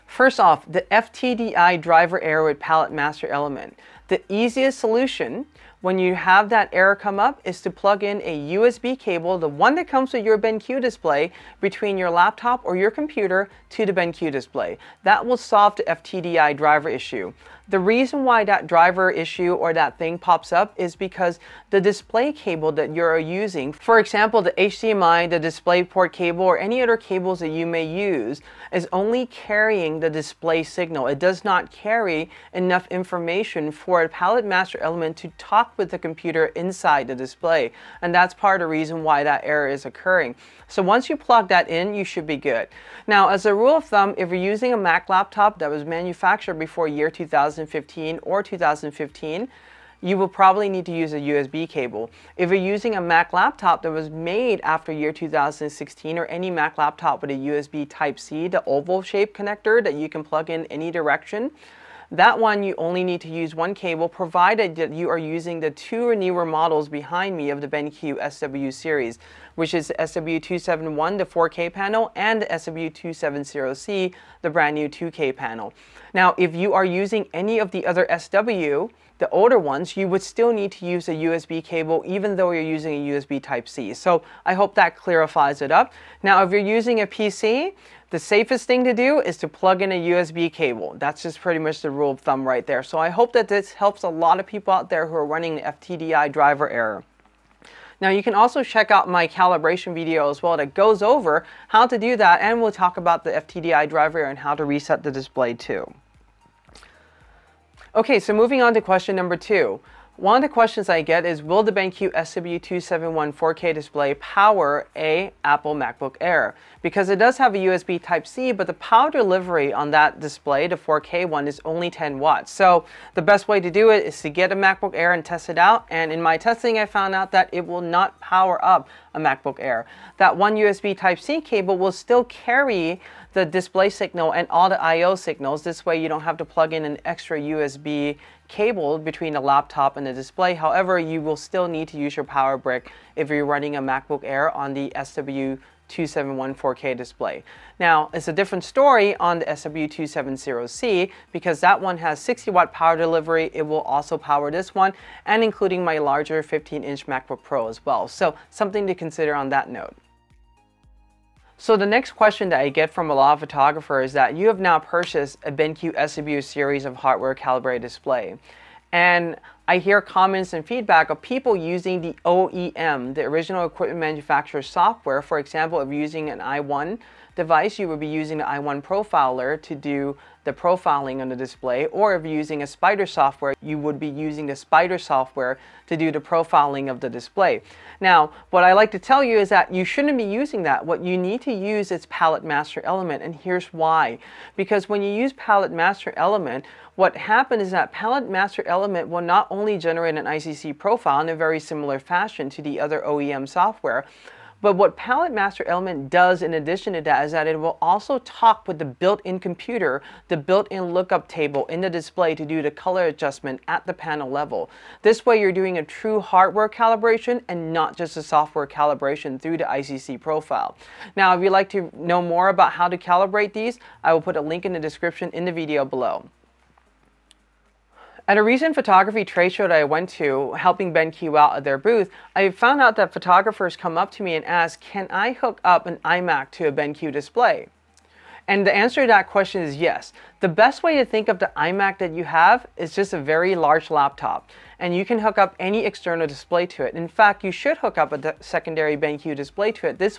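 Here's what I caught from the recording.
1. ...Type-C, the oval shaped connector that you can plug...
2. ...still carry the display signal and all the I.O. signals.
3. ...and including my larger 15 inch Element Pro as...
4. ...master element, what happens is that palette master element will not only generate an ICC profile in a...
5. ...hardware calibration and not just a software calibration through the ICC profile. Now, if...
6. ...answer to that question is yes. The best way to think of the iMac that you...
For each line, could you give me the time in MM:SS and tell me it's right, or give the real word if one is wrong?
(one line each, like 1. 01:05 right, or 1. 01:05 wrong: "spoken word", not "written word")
1. 00:57 right
2. 02:11 right
3. 02:35 wrong: "MacBook", not "Element"
4. 03:15 right
5. 03:36 right
6. 03:58 right.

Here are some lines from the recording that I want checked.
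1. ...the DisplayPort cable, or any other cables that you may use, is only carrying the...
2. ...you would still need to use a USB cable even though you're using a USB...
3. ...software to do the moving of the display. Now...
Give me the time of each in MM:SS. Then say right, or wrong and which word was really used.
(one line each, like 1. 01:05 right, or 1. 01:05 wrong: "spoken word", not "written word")
1. 00:25 right
2. 01:19 right
3. 03:04 wrong: "profiling", not "moving".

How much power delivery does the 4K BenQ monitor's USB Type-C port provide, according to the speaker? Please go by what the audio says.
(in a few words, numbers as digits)
10 watts.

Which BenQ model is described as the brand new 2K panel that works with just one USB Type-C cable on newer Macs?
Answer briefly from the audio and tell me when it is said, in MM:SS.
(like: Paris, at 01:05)
SW270C, at 01:12.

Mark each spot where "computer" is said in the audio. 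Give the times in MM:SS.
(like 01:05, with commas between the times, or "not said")
00:12, 00:35, 03:29.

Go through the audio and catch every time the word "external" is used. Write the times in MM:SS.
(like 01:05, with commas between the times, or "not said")
04:05.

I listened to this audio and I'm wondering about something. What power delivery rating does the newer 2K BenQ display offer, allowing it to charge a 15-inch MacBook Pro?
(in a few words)
60 watt.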